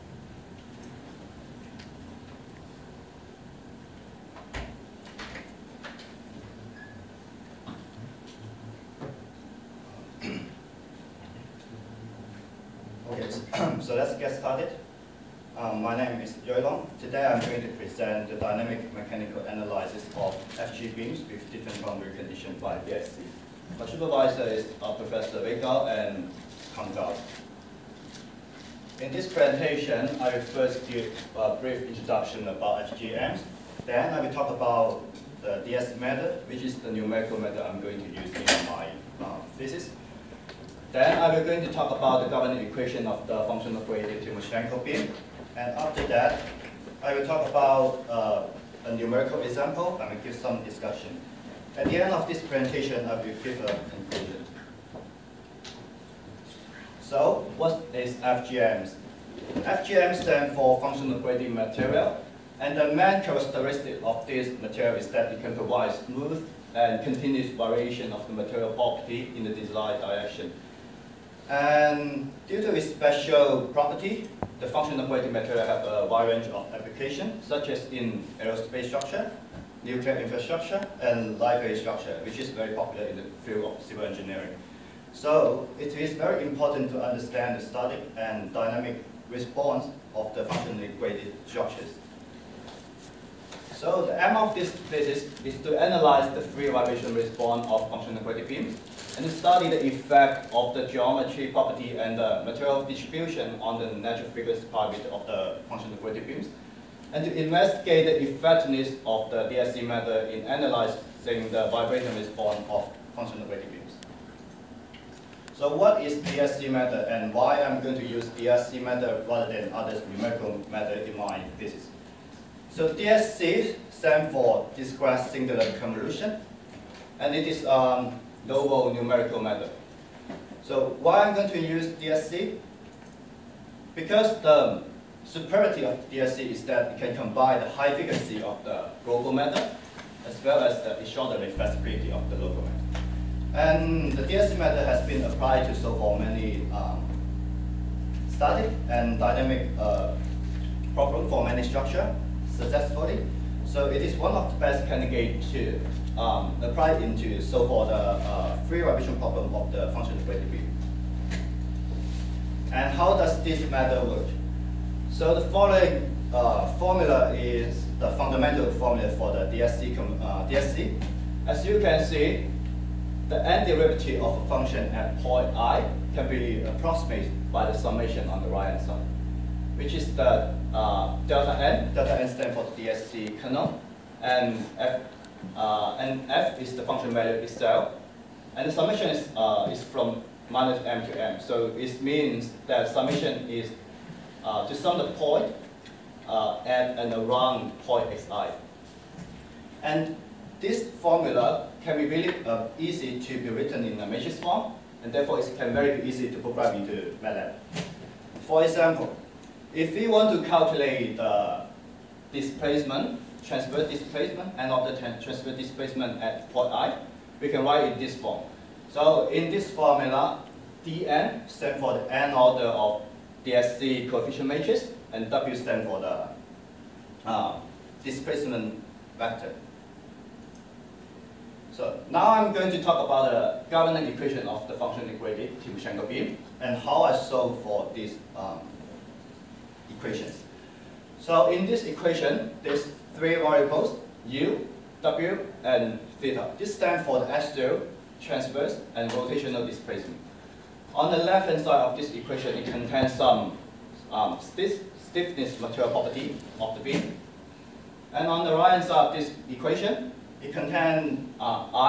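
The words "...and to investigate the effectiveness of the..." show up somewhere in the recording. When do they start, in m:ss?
1:47.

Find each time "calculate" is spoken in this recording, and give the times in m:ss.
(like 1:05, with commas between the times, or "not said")
3:30.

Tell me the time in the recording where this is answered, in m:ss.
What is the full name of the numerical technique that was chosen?
2:04.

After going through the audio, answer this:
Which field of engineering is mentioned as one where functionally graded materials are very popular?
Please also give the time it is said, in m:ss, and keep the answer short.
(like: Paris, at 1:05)
civil engineering, at 1:23.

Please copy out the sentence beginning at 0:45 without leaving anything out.
And after that, I will talk about uh, a numerical example and give some discussion.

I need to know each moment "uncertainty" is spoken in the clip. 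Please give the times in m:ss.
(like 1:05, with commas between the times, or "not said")
not said.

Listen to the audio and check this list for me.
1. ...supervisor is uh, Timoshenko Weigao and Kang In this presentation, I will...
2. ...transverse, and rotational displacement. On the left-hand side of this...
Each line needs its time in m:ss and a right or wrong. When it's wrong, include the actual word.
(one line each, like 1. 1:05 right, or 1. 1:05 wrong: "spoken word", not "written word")
1. 0:23 wrong: "Professor", not "Timoshenko"
2. 4:08 right.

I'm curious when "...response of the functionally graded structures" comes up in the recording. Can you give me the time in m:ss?
1:29.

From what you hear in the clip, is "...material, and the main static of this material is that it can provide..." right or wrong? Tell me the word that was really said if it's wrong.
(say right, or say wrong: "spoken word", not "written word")
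wrong: "characteristic", not "static".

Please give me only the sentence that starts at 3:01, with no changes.
Delta n stands for the DSC kernel, and f uh, and f is the function value itself.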